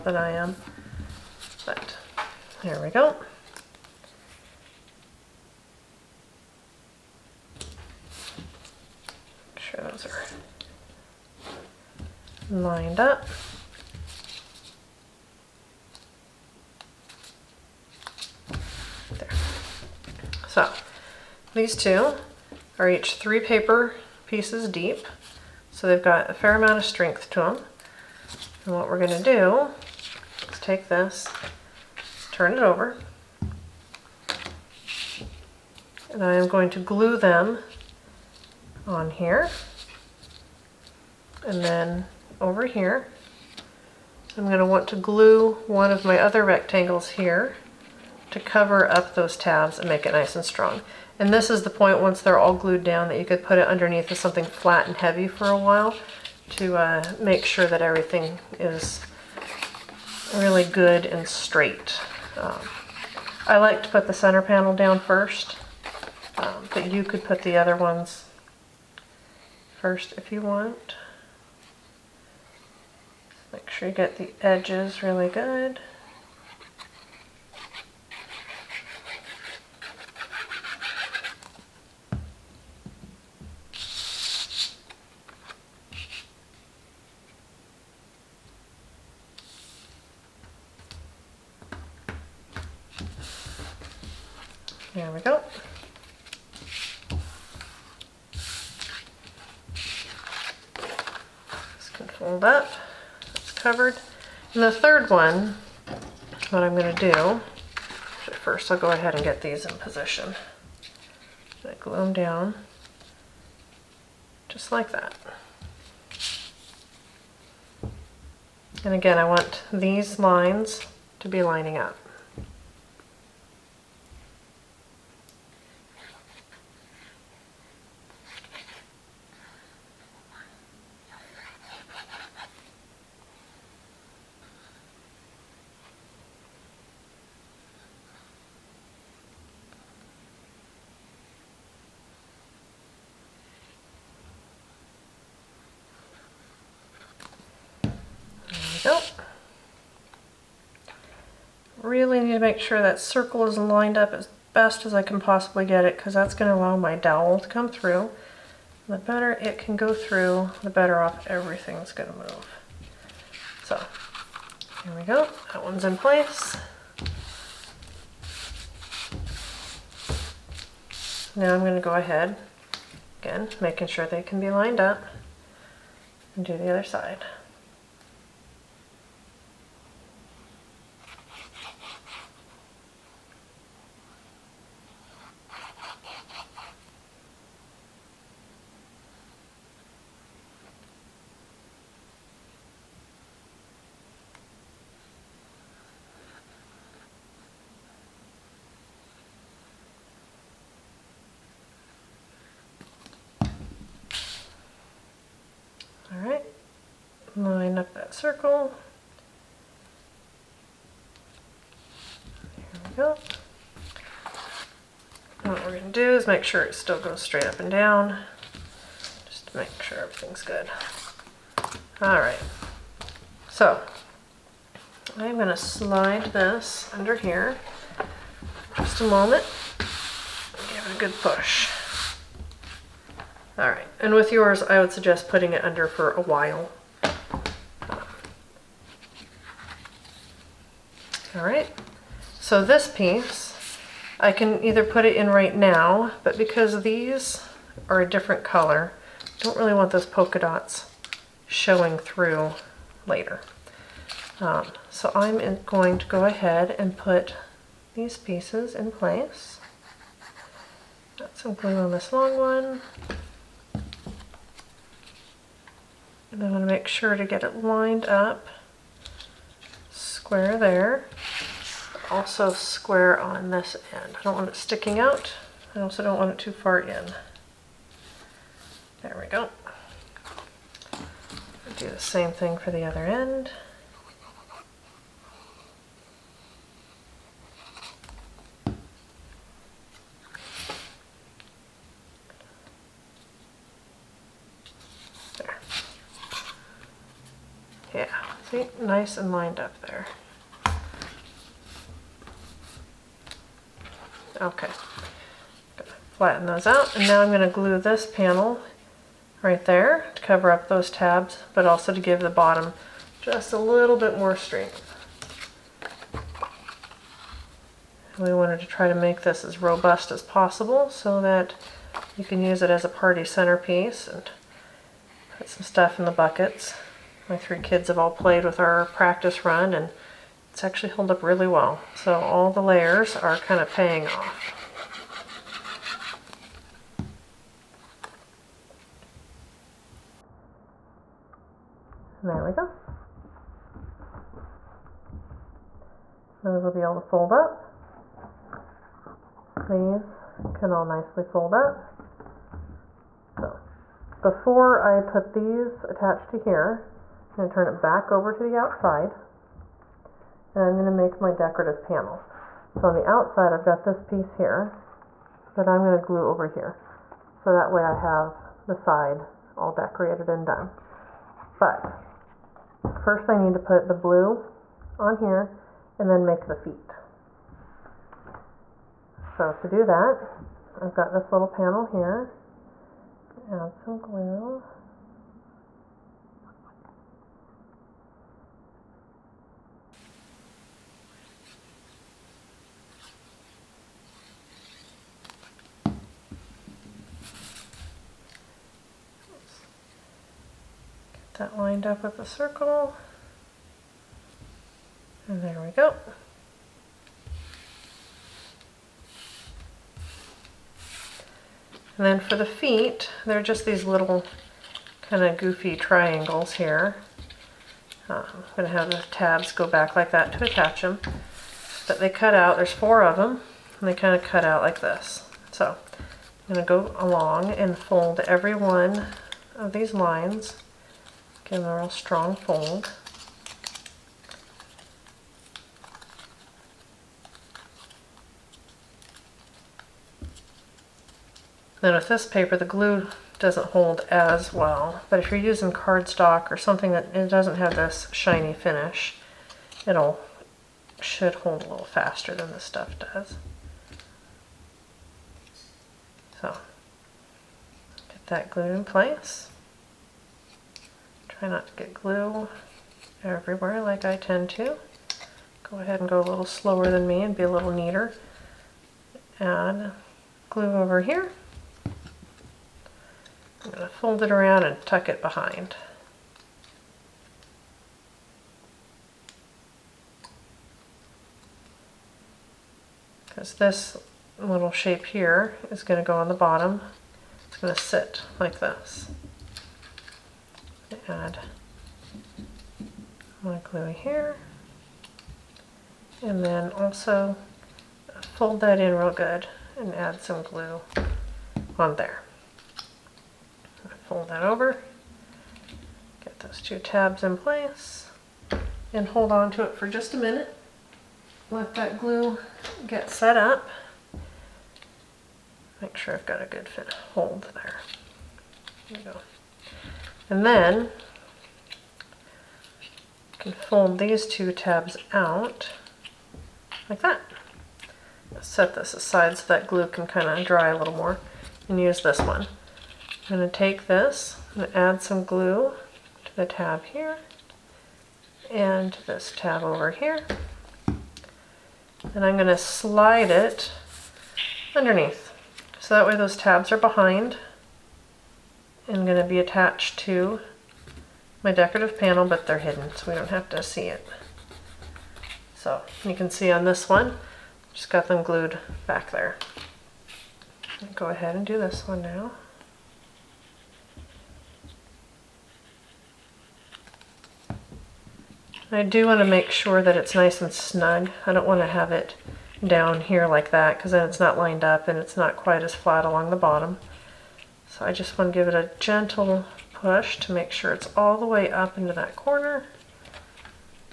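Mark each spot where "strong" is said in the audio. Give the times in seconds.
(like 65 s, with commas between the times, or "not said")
50 s, 431 s.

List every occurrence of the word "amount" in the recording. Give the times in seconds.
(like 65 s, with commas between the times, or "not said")
26 s.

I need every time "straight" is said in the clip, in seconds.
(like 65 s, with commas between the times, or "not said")
61 s, 217 s.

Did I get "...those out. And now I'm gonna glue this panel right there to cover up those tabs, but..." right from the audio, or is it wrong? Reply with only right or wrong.
right.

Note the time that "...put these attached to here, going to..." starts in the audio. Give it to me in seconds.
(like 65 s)
355 s.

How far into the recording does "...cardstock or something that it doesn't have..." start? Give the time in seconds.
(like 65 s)
445 s.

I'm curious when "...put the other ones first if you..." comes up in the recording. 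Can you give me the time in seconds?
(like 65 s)
67 s.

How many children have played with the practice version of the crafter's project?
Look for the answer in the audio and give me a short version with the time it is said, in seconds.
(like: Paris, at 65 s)
3, at 327 s.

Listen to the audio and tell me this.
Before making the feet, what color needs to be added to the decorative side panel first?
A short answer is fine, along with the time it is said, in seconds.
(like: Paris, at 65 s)
Blue, at 373 s.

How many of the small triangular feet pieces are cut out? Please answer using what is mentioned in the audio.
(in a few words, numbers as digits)
4.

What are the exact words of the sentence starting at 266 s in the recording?
And I going to make sure to get it lined up square there.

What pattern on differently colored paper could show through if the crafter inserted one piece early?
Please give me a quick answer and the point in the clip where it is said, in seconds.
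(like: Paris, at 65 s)
Polka dots, at 250 s.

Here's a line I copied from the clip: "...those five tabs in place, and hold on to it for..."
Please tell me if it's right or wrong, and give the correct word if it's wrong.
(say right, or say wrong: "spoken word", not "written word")
wrong: "two", not "five".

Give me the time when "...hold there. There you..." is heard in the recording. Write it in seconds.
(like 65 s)
517 s.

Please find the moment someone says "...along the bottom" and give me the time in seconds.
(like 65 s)
576 s.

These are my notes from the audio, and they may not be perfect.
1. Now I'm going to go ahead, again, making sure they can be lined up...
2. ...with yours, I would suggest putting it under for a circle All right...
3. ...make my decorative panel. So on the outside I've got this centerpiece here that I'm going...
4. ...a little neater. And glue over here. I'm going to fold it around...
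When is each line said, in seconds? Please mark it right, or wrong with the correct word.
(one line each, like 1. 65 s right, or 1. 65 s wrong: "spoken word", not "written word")
1. 171 s right
2. 234 s wrong: "while", not "circle"
3. 360 s wrong: "piece", not "centerpiece"
4. 467 s right.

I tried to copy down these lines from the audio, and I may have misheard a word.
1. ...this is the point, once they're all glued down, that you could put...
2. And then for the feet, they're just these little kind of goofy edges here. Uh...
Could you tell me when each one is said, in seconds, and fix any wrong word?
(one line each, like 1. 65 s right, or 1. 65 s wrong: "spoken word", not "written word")
1. 51 s right
2. 411 s wrong: "triangles", not "edges".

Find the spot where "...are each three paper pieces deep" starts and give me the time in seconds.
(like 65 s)
22 s.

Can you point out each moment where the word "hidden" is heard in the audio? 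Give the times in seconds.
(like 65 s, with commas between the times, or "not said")
552 s.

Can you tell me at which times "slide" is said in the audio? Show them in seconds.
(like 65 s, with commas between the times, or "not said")
225 s, 542 s.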